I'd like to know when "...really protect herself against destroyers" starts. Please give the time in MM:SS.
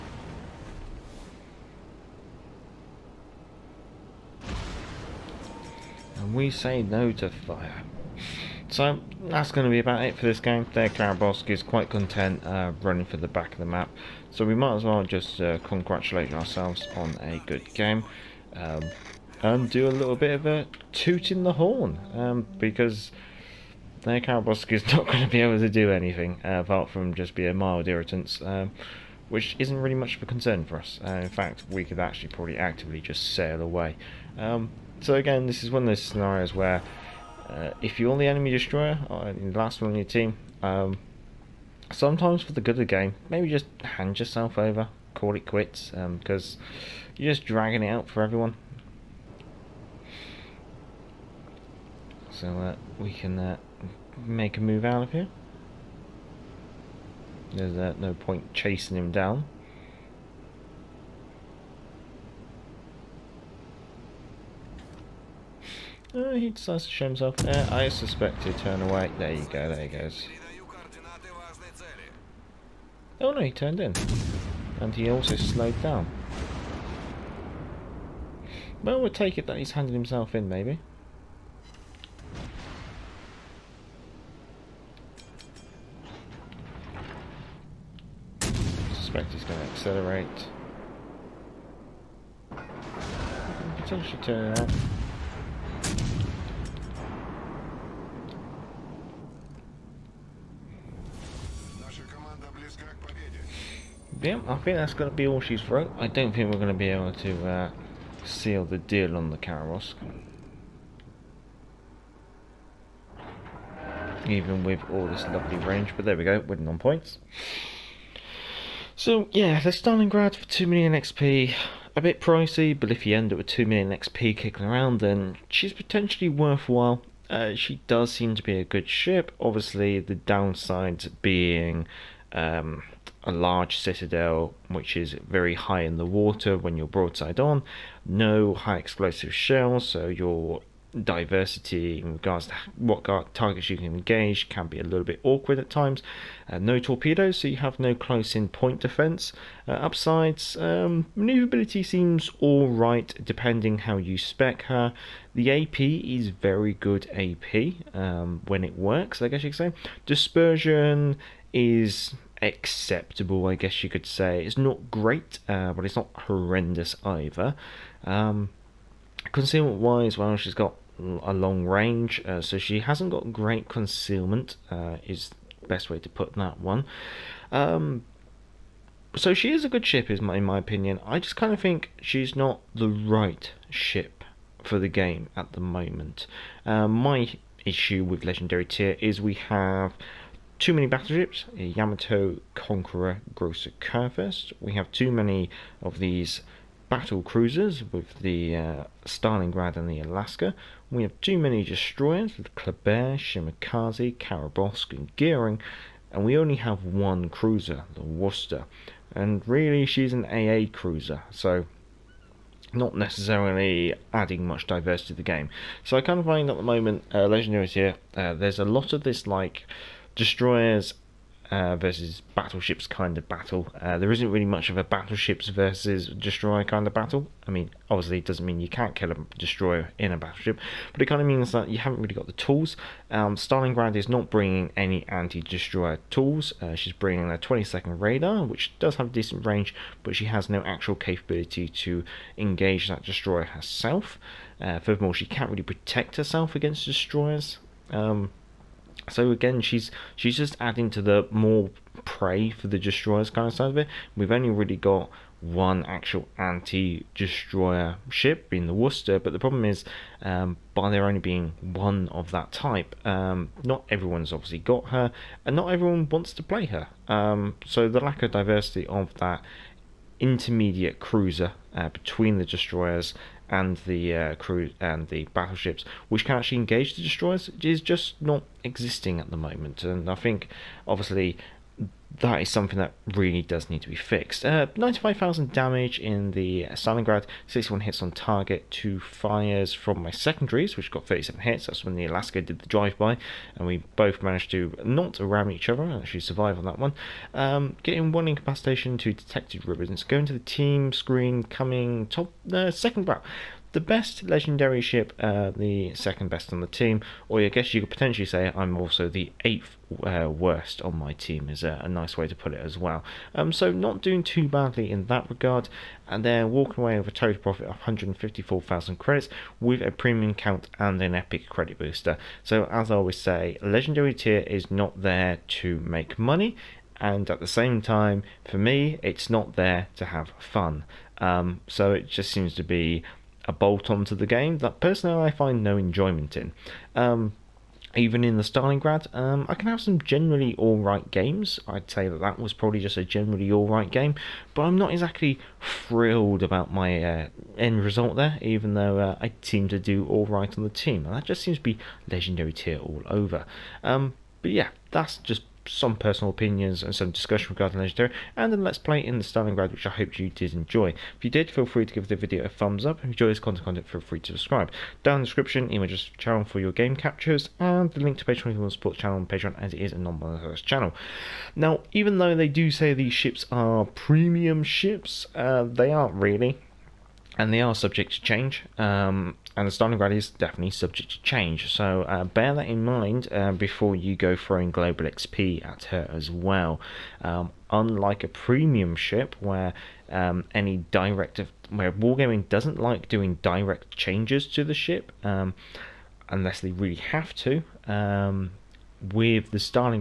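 04:05.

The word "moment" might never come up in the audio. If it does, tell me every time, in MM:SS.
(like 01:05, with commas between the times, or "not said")
03:05, 03:36, 04:39.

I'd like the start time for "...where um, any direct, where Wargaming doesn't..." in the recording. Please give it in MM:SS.
06:29.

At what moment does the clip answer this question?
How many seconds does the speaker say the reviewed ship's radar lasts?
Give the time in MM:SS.
03:57.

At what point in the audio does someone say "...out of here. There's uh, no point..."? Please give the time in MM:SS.
00:54.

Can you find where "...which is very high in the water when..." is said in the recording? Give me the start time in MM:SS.
02:14.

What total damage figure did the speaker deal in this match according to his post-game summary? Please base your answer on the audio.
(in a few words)
95,000.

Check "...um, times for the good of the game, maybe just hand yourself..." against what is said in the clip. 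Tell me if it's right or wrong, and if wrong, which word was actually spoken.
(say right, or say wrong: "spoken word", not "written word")
wrong: "sometimes", not "times".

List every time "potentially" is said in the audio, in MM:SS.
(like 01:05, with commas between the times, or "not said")
01:33, 02:05, 05:07.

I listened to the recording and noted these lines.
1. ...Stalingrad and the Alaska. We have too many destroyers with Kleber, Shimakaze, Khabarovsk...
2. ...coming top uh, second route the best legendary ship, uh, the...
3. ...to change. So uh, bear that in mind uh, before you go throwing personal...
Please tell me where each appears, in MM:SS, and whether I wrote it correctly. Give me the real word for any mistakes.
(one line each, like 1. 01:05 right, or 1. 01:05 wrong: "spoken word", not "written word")
1. 03:19 right
2. 05:01 right
3. 06:21 wrong: "global", not "personal".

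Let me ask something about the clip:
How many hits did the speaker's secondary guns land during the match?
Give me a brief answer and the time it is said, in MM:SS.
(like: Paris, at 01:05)
37, at 04:51.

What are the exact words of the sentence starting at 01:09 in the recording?
There you go, there he goes.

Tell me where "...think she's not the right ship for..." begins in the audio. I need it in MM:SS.
03:01.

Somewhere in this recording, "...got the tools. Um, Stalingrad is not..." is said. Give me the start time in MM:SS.
03:52.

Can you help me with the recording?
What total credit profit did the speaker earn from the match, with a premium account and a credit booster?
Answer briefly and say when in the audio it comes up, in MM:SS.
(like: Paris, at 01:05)
154,000 credits, at 05:17.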